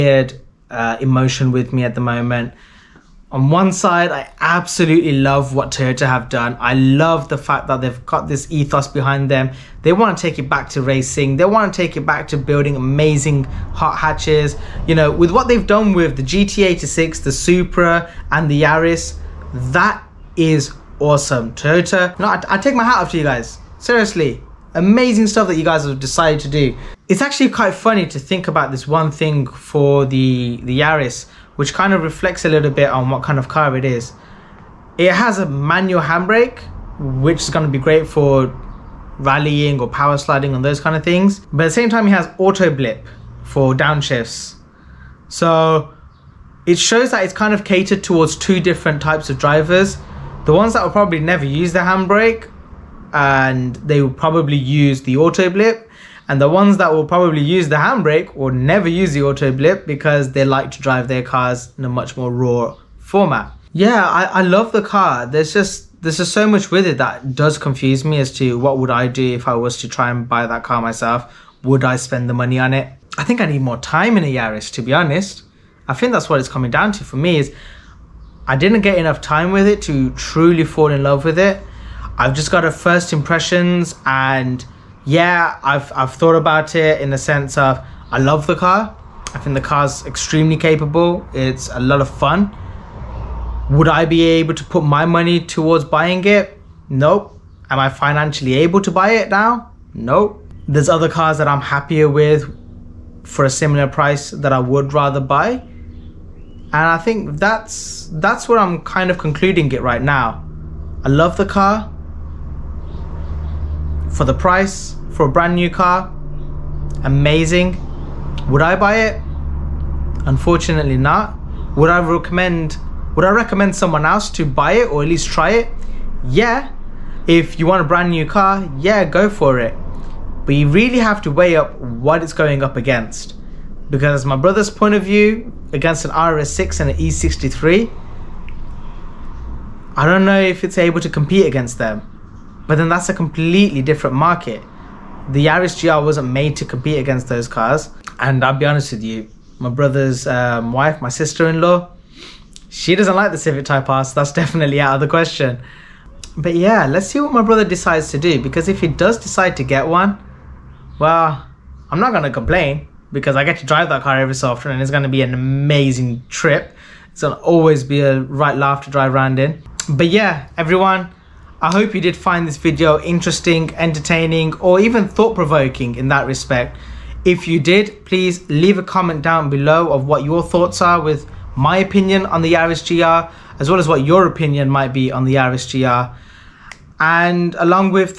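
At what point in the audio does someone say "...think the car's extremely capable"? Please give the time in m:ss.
1:29.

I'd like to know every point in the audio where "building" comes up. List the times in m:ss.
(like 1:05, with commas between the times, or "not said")
0:12.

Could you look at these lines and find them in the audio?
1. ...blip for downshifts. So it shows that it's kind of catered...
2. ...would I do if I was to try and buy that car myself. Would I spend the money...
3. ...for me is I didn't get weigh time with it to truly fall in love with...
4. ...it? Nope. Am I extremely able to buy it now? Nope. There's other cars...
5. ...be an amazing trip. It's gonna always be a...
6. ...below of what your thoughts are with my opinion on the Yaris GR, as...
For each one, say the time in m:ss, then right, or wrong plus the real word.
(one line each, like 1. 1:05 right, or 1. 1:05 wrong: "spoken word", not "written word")
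1. 0:42 right
2. 1:08 right
3. 1:17 wrong: "enough", not "weigh"
4. 1:36 wrong: "financially", not "extremely"
5. 2:45 right
6. 2:59 right.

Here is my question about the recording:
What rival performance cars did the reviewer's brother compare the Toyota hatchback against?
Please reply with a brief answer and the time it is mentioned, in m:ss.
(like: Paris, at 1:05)
RS6 or E63, at 2:16.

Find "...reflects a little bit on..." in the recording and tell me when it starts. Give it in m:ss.
0:32.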